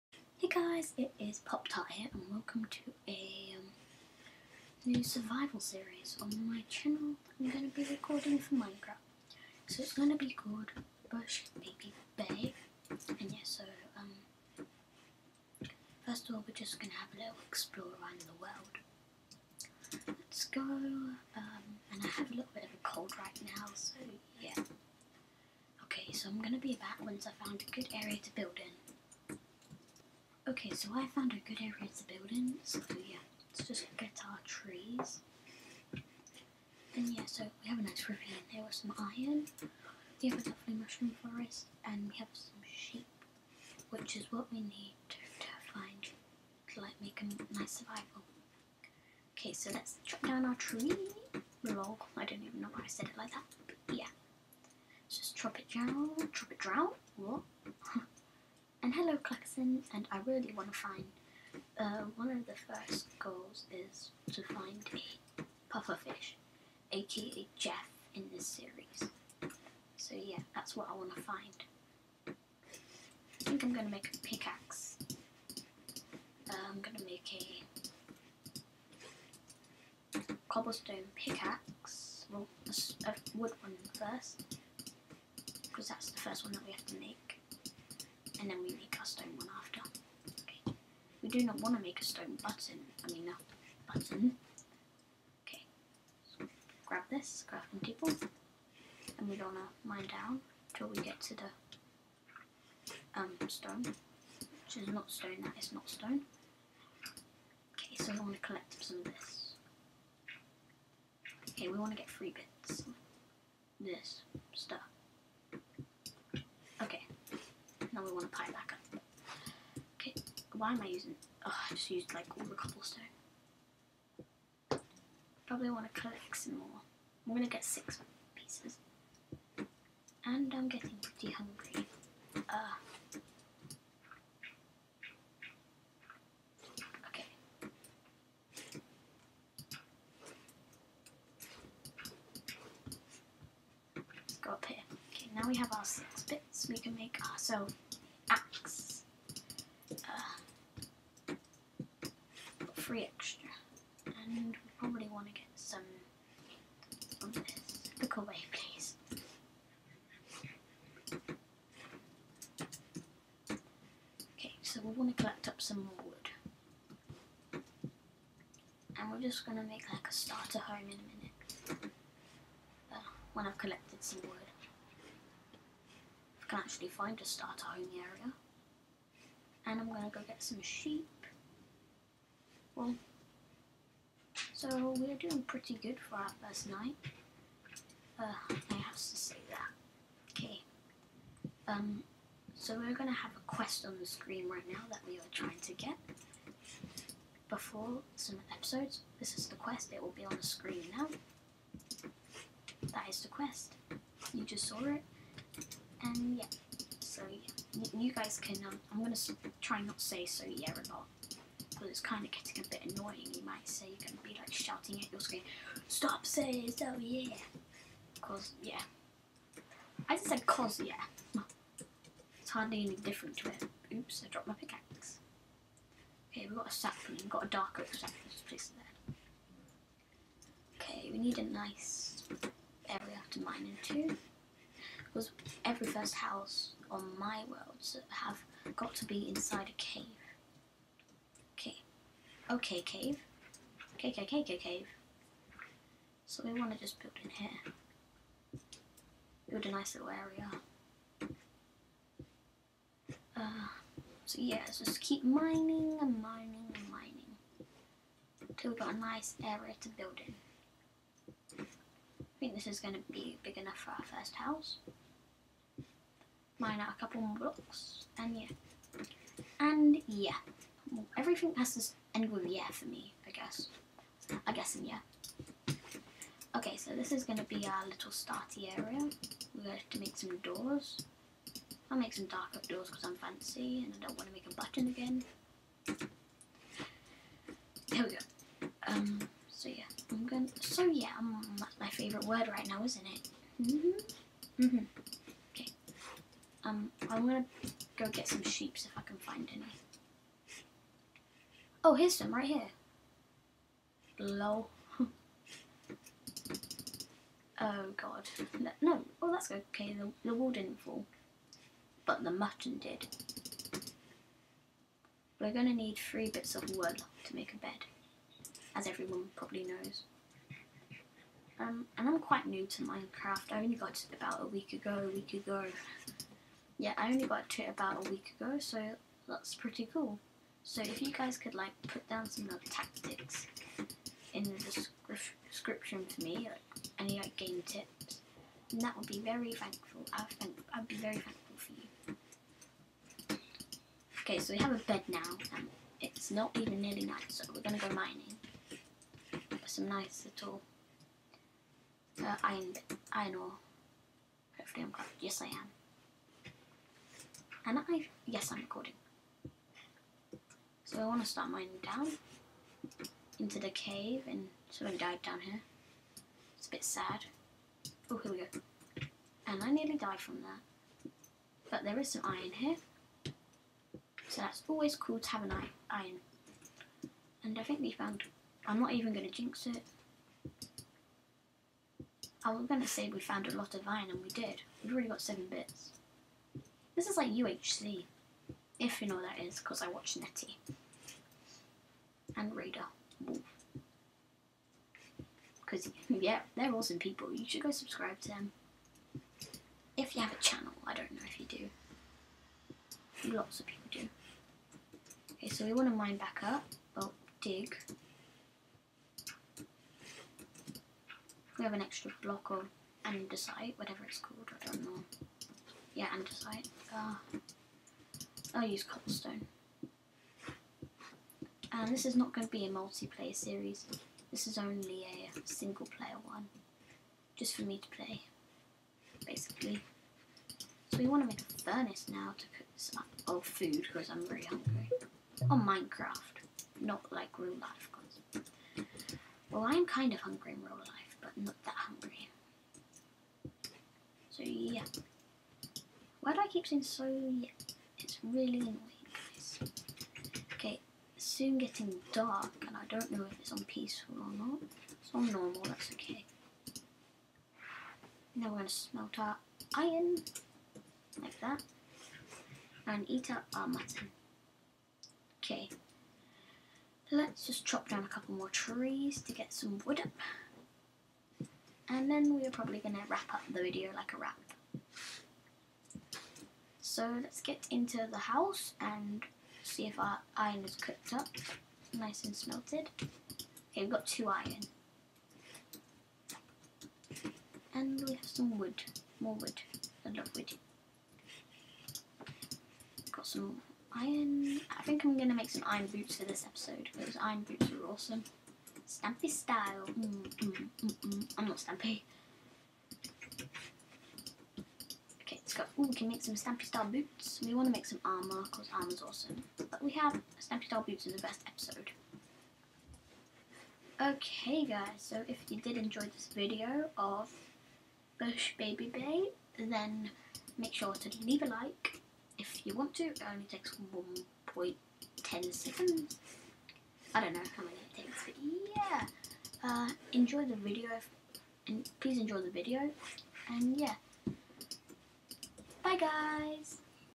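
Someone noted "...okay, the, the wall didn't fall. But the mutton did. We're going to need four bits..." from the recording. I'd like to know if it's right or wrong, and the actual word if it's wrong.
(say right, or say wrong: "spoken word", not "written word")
wrong: "three", not "four".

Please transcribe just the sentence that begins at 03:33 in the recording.
You're going to be like shouting at your screen, Stop saying over yeah.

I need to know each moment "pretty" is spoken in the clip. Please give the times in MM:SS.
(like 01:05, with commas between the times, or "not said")
02:11, 03:05, 05:29.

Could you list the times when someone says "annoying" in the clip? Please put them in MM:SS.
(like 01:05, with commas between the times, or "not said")
03:32, 07:28.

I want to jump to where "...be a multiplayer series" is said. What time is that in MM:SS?
07:02.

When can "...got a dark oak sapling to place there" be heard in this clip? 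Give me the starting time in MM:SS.
03:47.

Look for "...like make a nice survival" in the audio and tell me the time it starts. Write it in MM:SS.
00:46.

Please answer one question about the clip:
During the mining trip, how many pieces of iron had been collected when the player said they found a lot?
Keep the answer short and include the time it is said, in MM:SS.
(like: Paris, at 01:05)
7, at 06:25.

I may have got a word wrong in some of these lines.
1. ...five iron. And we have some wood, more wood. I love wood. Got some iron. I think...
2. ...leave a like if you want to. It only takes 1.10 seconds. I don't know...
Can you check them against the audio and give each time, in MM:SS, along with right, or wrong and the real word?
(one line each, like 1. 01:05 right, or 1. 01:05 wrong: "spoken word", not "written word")
1. 08:04 wrong: "two", not "five"
2. 08:41 right.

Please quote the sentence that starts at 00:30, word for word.
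Okay, so I found a good area to build in, so yeah, let's just get our trees.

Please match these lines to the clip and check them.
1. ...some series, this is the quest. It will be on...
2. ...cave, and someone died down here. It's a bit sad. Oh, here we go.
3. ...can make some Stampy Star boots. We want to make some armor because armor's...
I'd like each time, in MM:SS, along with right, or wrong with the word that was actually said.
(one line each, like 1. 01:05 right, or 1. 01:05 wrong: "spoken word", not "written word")
1. 03:18 wrong: "episodes", not "series"
2. 06:03 right
3. 08:25 right.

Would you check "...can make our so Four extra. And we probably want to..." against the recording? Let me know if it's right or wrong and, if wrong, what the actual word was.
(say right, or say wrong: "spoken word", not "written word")
wrong: "Three", not "Four".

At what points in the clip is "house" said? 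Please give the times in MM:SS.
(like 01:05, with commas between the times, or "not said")
03:56, 04:24, 07:58.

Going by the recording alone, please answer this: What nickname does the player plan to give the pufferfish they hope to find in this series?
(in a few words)
Jeff.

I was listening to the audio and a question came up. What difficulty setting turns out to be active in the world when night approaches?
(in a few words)
Normal.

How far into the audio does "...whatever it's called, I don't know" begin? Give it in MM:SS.
06:53.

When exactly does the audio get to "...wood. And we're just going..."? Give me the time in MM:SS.
02:47.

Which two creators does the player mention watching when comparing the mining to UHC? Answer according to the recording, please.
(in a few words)
Nettie and Raider.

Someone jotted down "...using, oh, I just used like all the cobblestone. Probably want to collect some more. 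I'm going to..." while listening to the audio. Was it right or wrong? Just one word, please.
right.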